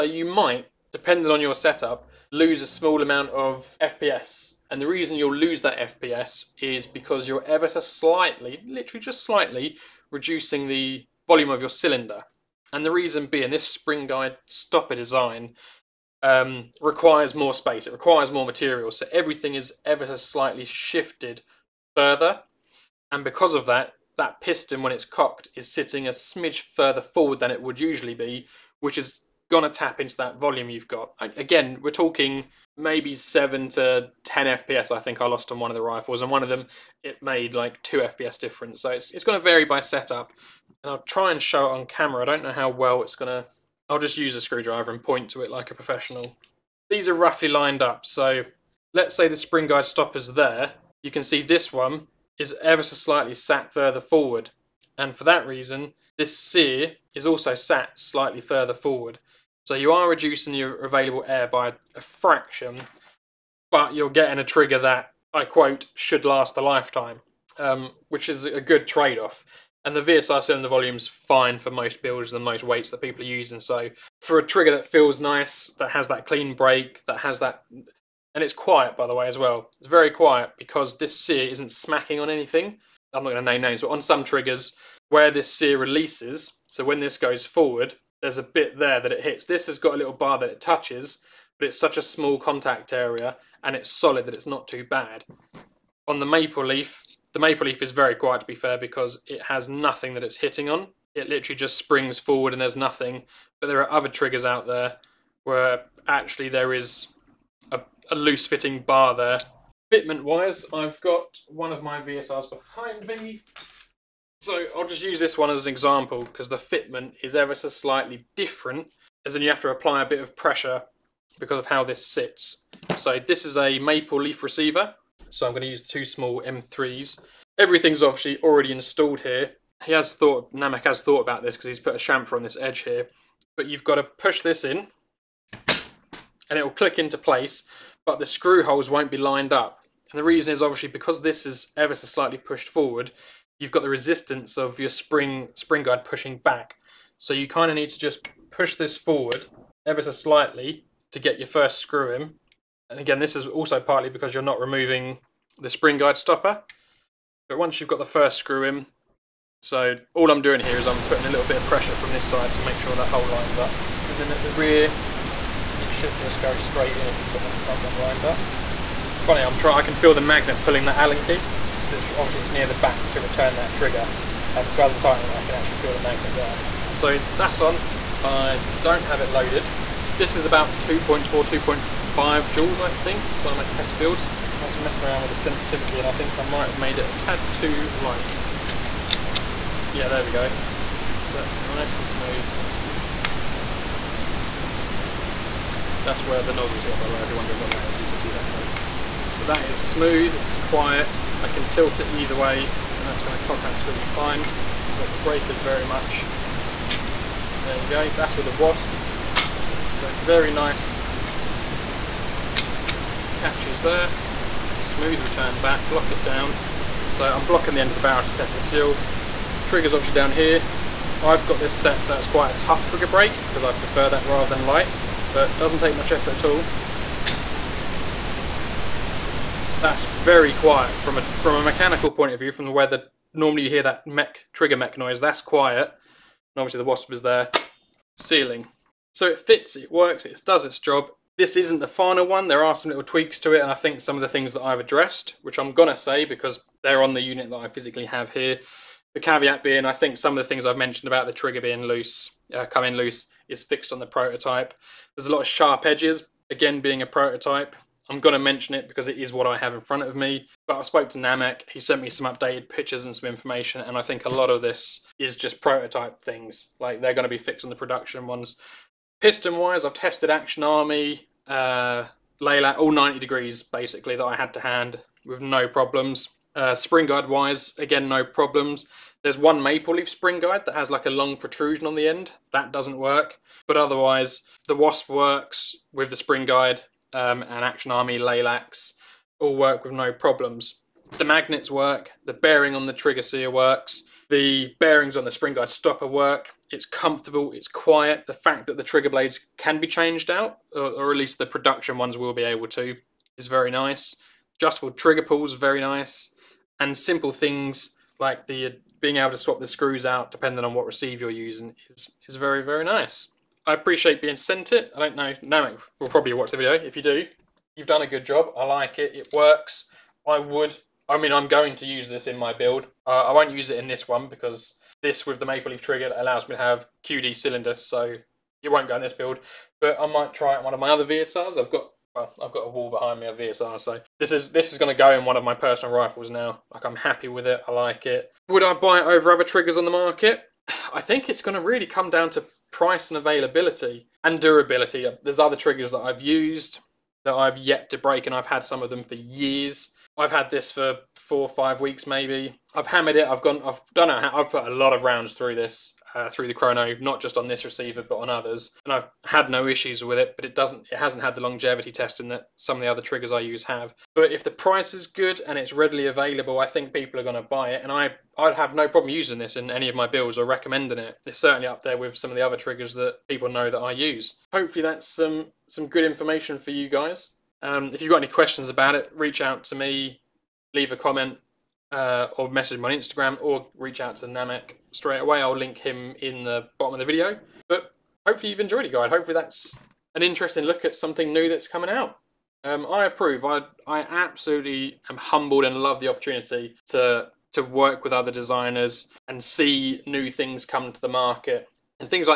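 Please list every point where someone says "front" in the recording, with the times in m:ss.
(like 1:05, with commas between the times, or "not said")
2:47, 4:19.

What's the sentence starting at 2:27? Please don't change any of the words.
So you kind of need to just push this forward ever so slightly to get your first screw in.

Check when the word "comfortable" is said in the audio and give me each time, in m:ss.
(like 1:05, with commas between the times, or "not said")
4:56.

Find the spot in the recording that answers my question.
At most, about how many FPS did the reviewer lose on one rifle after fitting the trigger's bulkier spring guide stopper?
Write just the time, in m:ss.
0:33.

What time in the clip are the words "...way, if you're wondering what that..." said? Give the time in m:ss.
3:17.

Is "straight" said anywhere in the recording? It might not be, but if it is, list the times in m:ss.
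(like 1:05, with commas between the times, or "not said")
2:46, 6:24.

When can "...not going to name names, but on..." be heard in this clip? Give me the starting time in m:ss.
1:23.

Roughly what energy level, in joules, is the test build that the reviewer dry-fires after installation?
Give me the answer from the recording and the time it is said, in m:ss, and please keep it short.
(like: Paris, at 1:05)
2.4 to 2.5 joules, at 3:00.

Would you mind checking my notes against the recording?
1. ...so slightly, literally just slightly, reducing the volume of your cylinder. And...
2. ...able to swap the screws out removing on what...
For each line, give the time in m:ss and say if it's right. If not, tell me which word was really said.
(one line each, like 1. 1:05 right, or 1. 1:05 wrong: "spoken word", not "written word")
1. 0:07 right
2. 5:09 wrong: "depending", not "removing".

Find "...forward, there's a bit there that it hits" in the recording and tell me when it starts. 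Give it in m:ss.
1:27.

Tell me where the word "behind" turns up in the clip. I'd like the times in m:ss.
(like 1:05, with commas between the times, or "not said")
1:52, 5:32.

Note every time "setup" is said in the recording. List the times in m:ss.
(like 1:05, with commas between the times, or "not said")
0:01, 0:39.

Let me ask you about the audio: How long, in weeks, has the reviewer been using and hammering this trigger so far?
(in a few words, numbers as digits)
4 or 5 weeks.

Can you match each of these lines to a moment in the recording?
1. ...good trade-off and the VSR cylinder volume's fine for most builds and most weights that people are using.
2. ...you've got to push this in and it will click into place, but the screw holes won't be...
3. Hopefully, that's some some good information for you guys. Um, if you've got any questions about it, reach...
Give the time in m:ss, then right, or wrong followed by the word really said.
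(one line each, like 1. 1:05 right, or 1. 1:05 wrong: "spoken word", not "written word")
1. 1:08 right
2. 2:13 right
3. 6:14 right.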